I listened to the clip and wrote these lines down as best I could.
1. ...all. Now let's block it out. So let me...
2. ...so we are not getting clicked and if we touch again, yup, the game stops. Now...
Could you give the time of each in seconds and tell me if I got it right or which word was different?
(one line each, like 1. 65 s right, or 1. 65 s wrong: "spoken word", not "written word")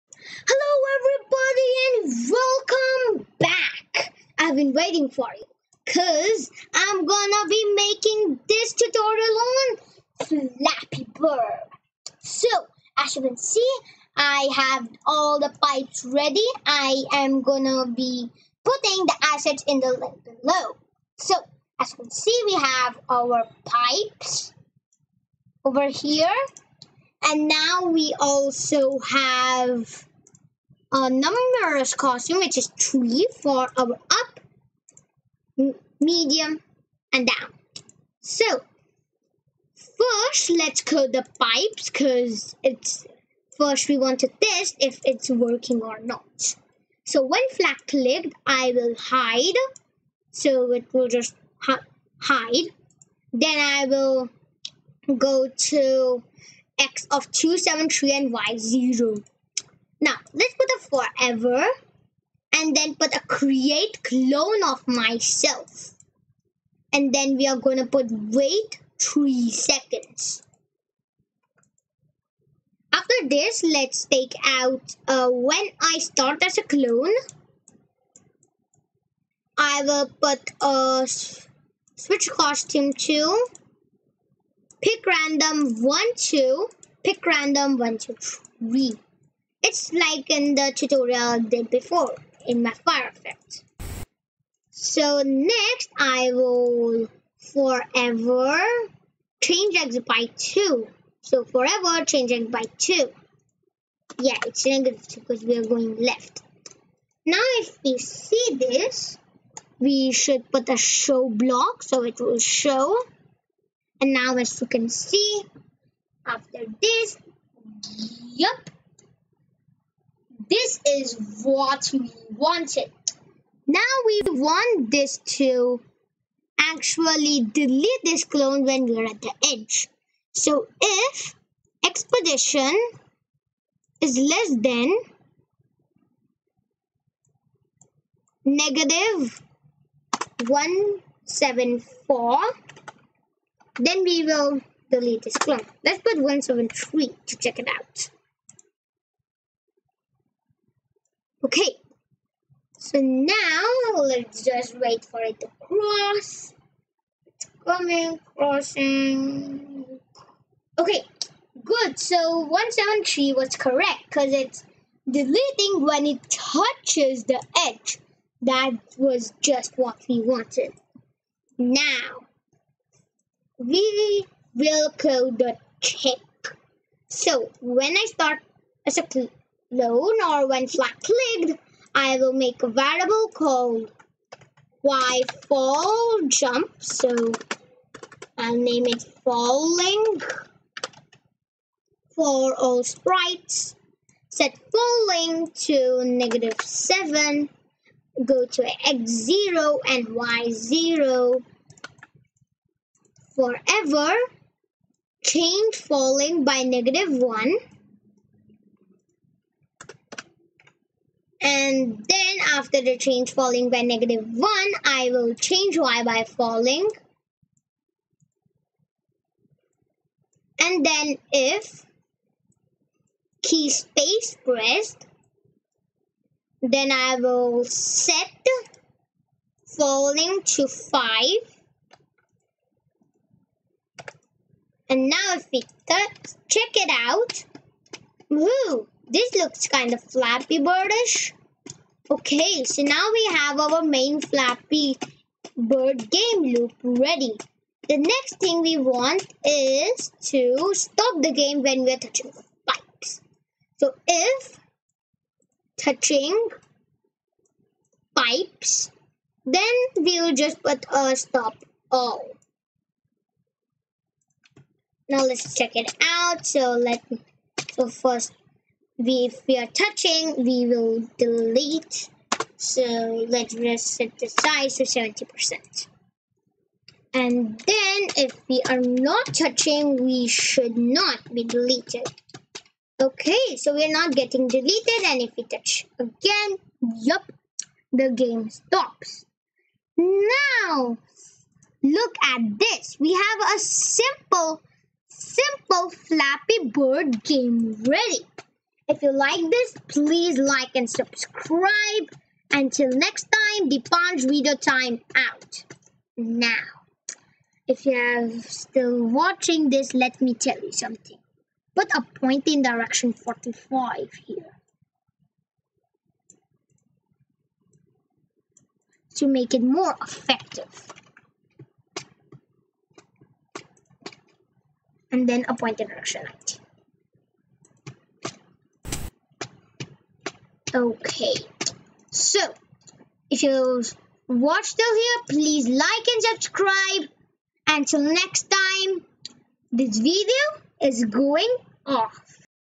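1. 261 s wrong: "check", not "block"
2. 283 s wrong: "deleted", not "clicked".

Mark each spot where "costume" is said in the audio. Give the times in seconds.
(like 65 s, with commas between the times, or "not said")
31 s, 82 s.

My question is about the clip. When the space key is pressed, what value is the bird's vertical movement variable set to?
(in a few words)
5.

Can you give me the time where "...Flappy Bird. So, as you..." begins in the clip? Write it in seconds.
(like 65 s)
10 s.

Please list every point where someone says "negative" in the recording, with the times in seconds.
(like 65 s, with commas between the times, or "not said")
104 s, 138 s, 196 s, 206 s, 213 s.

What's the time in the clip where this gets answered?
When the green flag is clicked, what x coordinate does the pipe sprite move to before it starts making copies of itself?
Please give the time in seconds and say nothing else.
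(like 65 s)
57 s.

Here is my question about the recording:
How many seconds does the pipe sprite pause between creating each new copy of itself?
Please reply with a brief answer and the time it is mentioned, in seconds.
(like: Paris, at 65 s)
3 seconds, at 68 s.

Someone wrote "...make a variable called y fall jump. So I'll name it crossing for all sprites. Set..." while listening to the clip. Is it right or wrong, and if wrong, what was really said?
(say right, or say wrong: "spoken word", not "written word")
wrong: "falling", not "crossing".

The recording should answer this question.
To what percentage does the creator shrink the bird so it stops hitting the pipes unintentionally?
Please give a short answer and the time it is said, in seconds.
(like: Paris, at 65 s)
70%, at 274 s.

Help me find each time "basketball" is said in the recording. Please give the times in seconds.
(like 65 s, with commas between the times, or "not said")
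not said.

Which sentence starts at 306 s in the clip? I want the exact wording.
Now, if you are still watching this, let me tell you something.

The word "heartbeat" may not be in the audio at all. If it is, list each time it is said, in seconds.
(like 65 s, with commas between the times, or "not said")
not said.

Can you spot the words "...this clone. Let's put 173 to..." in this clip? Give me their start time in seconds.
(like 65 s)
145 s.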